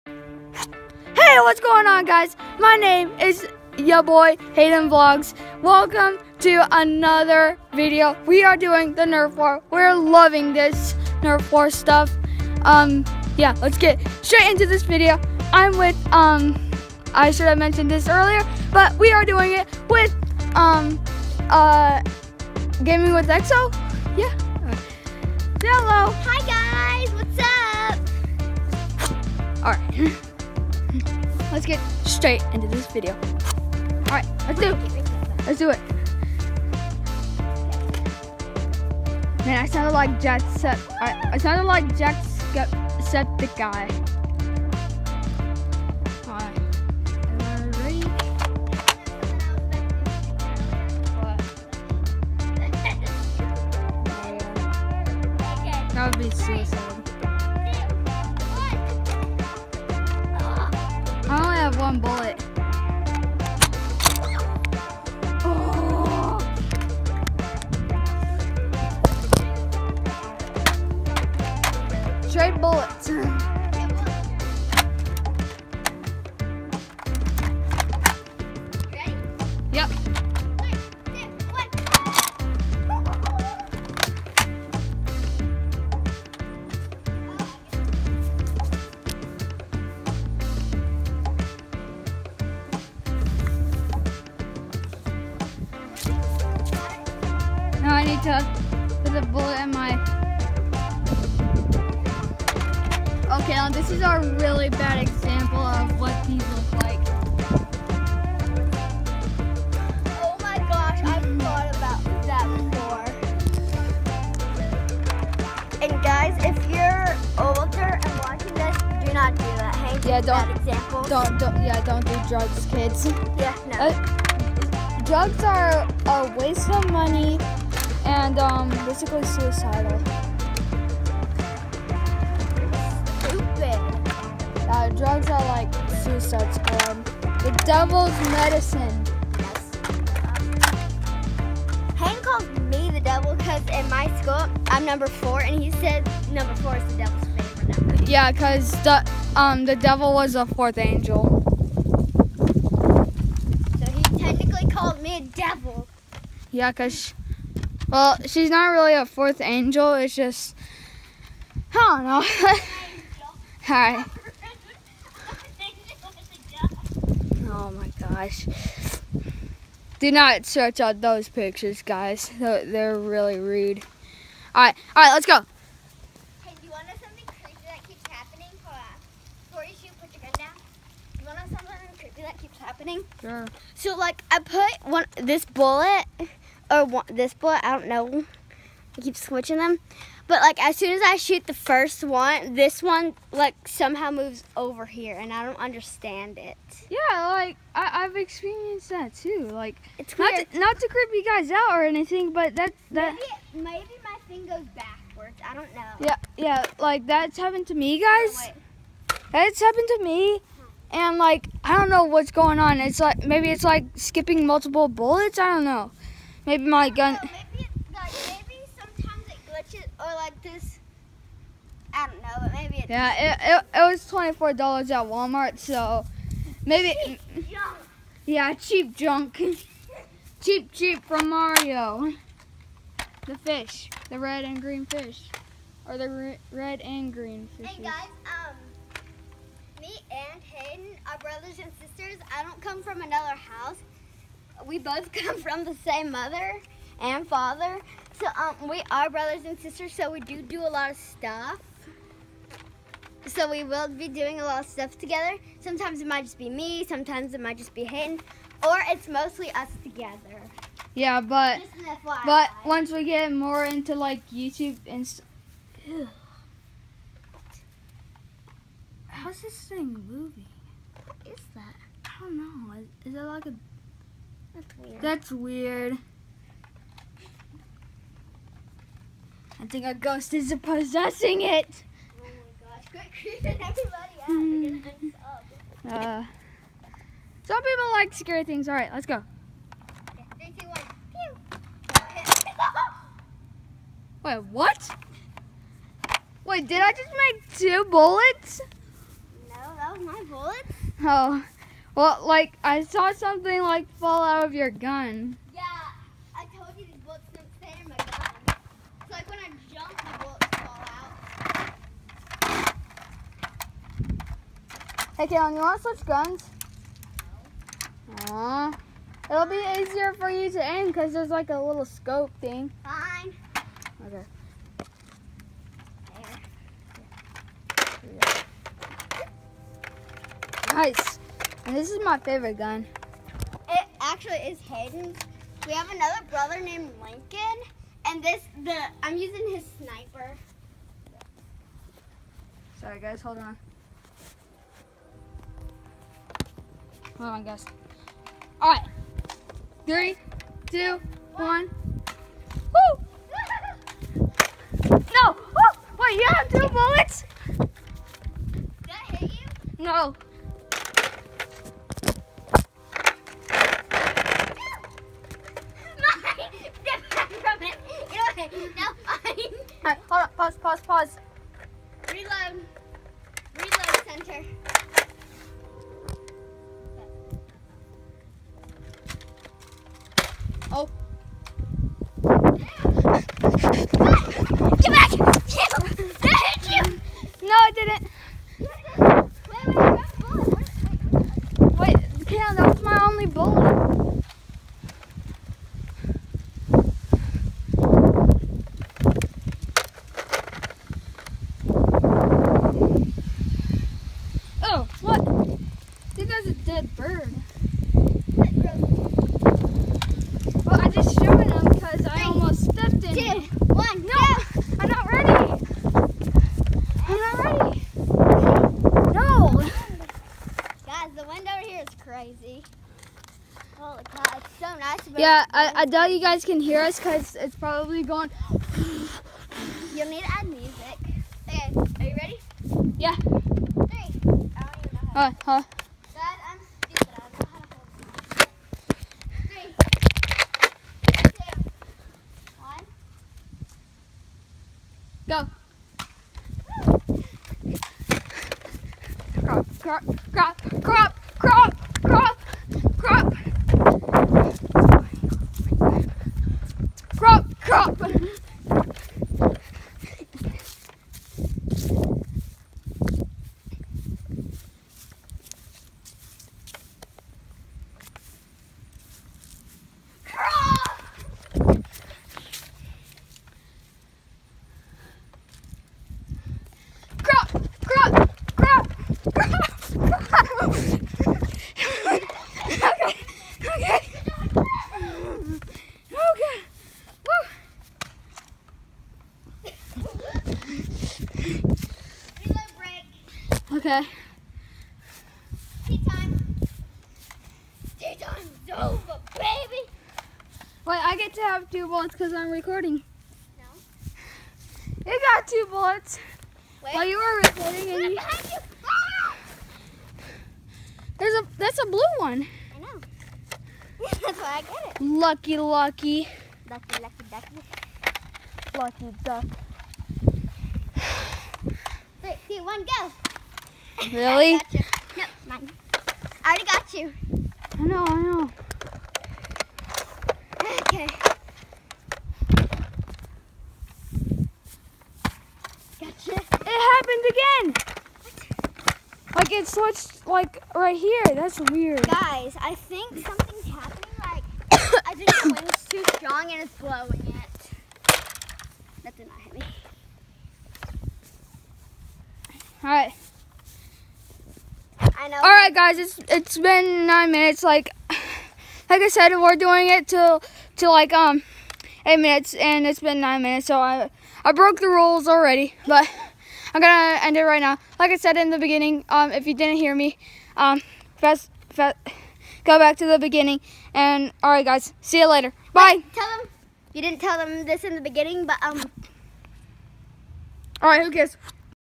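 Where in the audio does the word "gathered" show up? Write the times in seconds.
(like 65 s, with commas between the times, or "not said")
not said.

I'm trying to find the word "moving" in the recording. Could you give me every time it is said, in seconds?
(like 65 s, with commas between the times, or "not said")
270 s.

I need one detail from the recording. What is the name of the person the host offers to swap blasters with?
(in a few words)
Kaylin.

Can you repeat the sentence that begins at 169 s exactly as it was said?
Do not search out those pictures, guys.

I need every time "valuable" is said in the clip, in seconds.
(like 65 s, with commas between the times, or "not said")
not said.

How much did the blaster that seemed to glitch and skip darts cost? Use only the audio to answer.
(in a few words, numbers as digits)
$24.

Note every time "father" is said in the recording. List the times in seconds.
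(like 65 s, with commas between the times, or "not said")
247 s.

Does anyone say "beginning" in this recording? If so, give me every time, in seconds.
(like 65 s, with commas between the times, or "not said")
568 s, 573 s, 578 s.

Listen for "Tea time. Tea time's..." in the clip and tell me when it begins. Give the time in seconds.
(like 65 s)
495 s.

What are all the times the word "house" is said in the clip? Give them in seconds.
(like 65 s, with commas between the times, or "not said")
243 s.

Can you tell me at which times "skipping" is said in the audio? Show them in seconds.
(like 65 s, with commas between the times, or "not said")
213 s.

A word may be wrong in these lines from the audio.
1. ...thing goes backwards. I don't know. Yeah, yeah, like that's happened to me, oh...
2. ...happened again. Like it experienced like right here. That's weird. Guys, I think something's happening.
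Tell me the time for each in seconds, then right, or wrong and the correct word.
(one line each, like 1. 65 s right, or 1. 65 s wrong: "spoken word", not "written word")
1. 204 s right
2. 536 s wrong: "switched", not "experienced".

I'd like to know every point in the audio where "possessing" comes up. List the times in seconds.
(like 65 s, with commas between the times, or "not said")
280 s.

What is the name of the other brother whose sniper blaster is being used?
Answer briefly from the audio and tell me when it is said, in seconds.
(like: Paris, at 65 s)
Lincoln, at 337 s.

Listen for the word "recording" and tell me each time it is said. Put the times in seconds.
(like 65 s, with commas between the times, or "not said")
502 s, 507 s.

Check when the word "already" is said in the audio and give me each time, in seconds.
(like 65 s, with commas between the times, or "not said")
526 s, 565 s.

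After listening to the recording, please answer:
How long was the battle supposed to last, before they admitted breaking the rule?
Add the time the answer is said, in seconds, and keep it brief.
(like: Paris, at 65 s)
8 minutes, at 562 s.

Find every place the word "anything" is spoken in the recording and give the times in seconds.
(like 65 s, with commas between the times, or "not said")
201 s.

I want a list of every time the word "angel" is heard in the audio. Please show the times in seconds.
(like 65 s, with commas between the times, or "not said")
150 s, 159 s.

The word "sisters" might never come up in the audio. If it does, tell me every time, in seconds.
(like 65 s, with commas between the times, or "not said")
241 s, 249 s.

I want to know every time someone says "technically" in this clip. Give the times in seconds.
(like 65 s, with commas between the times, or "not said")
154 s.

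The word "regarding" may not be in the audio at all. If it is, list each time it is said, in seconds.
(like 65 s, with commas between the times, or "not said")
not said.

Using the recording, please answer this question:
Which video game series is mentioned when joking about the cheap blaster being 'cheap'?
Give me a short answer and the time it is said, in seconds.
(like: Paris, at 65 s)
Mario, at 231 s.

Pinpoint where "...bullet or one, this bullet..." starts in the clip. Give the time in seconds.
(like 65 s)
185 s.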